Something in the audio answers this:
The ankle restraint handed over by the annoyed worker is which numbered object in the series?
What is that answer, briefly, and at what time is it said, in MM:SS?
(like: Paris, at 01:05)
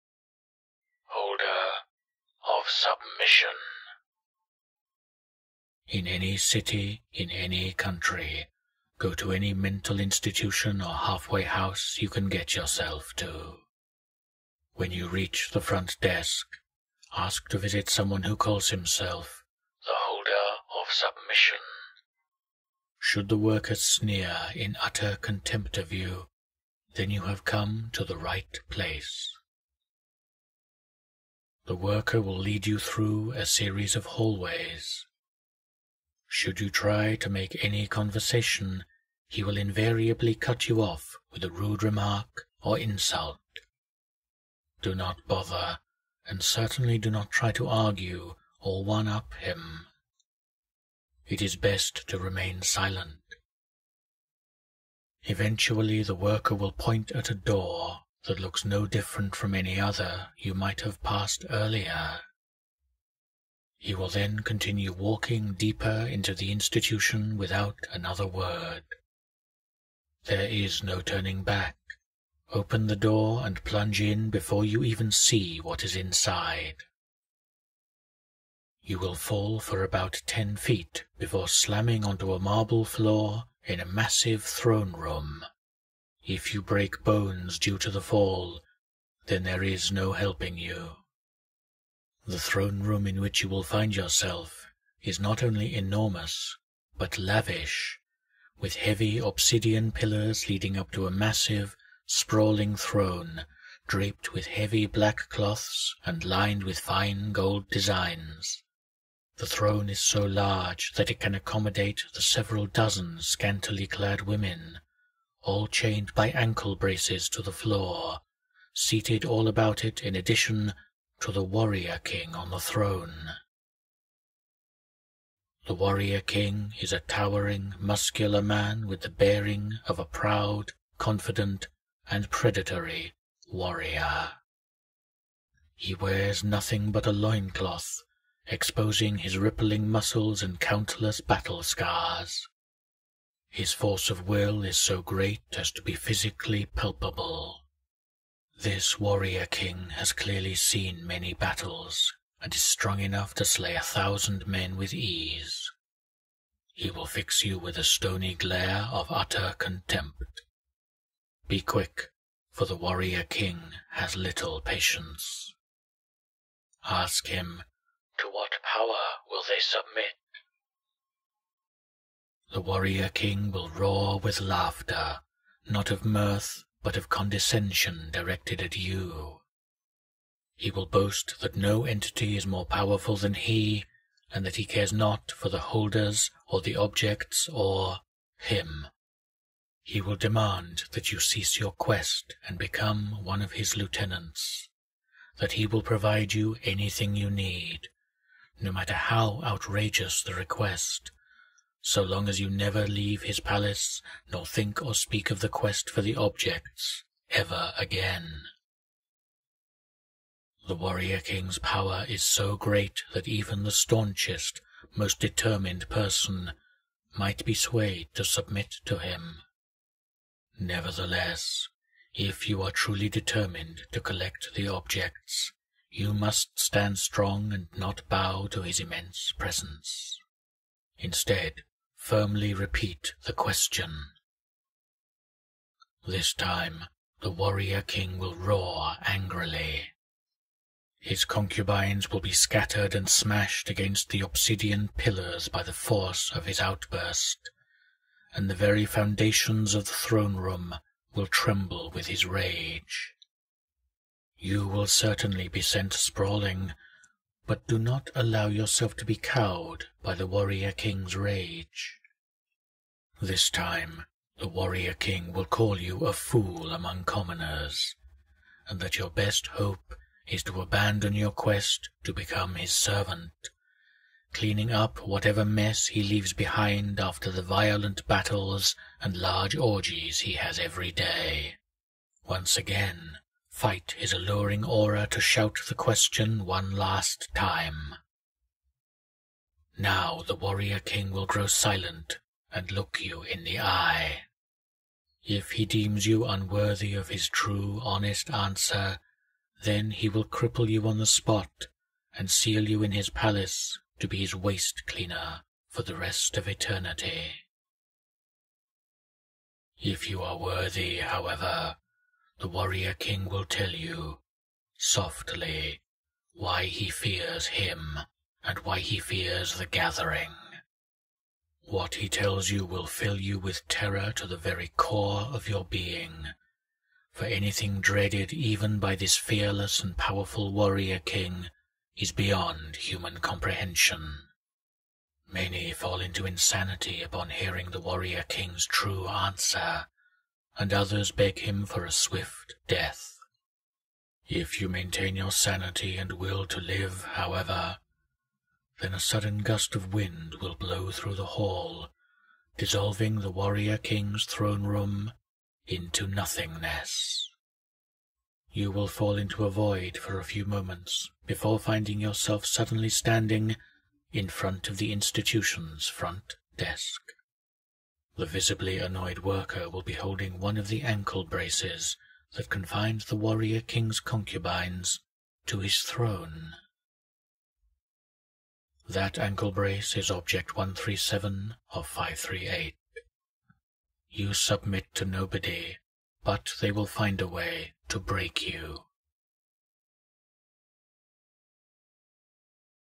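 137, at 06:20.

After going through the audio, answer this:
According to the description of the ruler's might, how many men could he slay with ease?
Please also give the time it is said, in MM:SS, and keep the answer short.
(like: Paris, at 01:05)
1000, at 02:33.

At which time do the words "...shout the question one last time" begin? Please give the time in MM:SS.
04:45.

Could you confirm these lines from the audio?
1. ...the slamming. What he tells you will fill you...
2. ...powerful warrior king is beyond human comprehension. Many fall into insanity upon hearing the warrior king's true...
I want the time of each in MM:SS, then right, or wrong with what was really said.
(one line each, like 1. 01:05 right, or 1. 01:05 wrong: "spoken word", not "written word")
1. 05:19 wrong: "gathering", not "slamming"
2. 05:29 right.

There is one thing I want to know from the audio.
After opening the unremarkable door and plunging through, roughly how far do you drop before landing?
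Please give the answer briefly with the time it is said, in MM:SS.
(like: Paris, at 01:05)
10 feet, at 01:20.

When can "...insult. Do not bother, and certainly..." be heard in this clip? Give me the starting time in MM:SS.
00:42.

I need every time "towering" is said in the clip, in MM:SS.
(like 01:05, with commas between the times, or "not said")
02:06.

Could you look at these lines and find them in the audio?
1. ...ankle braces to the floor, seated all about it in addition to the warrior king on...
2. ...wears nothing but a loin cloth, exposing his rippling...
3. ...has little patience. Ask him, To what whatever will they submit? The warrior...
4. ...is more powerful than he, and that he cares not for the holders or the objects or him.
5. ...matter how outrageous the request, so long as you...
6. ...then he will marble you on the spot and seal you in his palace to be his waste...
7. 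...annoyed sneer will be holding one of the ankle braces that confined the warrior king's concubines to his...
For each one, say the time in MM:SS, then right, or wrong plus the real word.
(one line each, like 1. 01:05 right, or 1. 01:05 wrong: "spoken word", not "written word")
1. 01:56 right
2. 02:15 right
3. 02:43 wrong: "power", not "whatever"
4. 03:02 right
5. 03:18 right
6. 04:59 wrong: "cripple", not "marble"
7. 06:08 wrong: "worker", not "sneer".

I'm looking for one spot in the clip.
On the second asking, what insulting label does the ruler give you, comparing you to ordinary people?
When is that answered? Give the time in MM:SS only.
04:26.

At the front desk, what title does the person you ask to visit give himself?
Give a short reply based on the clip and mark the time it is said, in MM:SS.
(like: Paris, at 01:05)
holder of submission, at 00:19.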